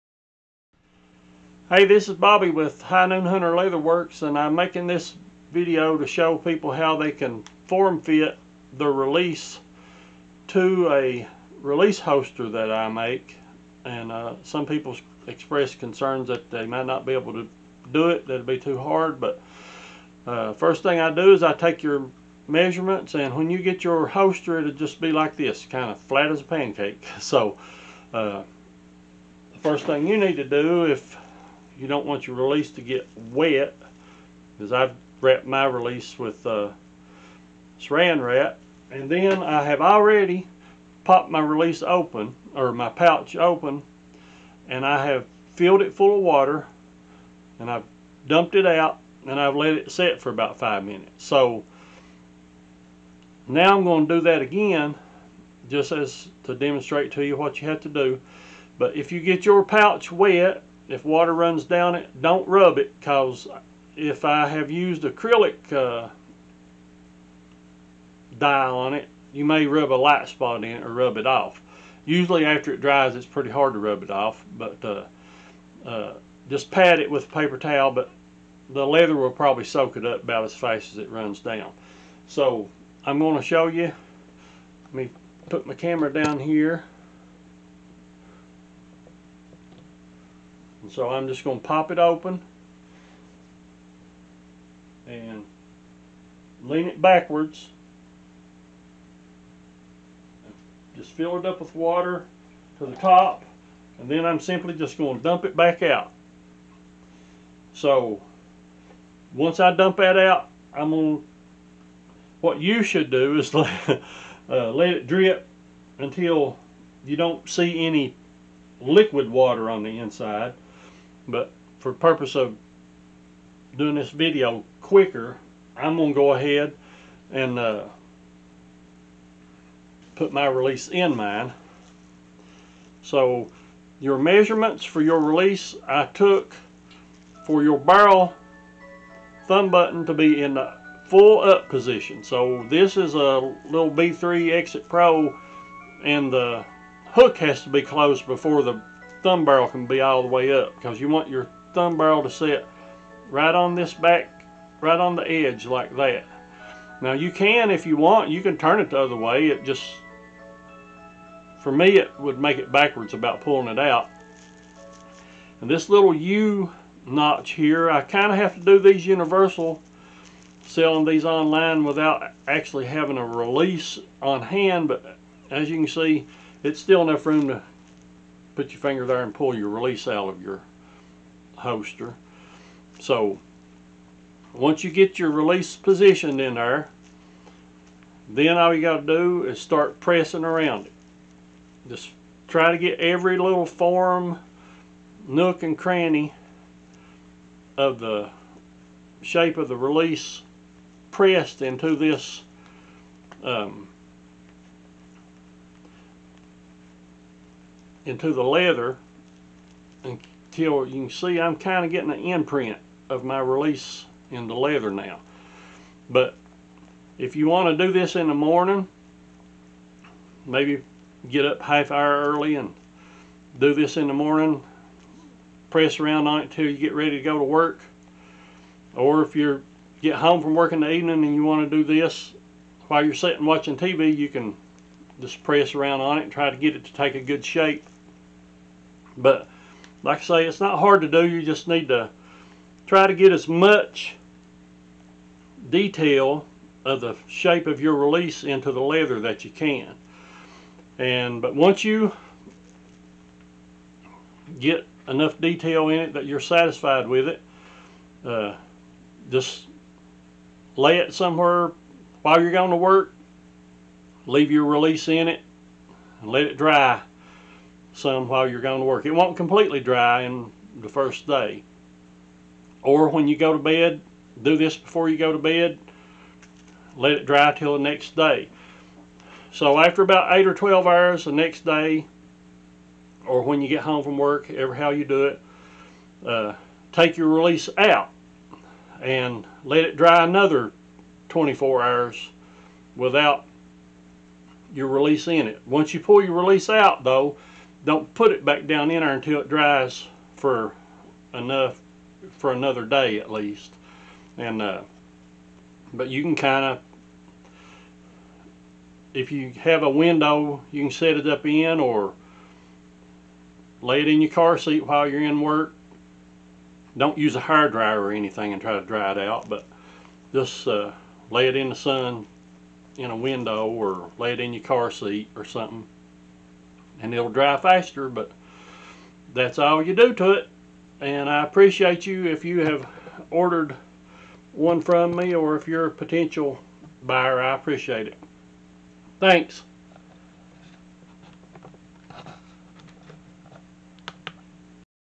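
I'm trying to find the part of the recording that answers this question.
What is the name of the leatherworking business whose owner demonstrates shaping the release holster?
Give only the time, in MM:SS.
00:02.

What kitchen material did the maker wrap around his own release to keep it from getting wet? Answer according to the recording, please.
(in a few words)
saran wrap.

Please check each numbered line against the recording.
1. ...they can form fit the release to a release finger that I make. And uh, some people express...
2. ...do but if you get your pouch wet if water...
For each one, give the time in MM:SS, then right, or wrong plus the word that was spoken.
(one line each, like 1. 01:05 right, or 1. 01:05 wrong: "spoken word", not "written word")
1. 00:06 wrong: "holster", not "finger"
2. 00:57 right.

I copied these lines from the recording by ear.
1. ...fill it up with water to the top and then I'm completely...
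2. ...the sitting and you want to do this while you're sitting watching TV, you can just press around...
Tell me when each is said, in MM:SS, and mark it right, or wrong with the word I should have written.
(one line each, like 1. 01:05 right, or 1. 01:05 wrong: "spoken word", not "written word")
1. 01:41 wrong: "simply", not "completely"
2. 03:50 wrong: "evening", not "sitting".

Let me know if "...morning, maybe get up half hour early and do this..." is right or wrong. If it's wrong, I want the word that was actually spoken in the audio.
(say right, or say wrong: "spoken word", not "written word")
right.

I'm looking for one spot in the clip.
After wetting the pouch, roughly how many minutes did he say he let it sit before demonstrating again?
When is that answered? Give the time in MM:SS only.
00:50.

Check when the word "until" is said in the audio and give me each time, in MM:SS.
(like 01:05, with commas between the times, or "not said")
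01:55, 03:30, 03:46, 04:59.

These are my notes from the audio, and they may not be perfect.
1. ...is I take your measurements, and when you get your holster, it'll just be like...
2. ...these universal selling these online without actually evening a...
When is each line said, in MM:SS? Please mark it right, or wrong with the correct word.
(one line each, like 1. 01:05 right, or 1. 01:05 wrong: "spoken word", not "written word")
1. 00:21 right
2. 02:48 wrong: "having", not "evening".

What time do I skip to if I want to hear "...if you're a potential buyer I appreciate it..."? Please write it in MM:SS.
05:35.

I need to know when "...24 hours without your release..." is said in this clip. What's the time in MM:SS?
04:51.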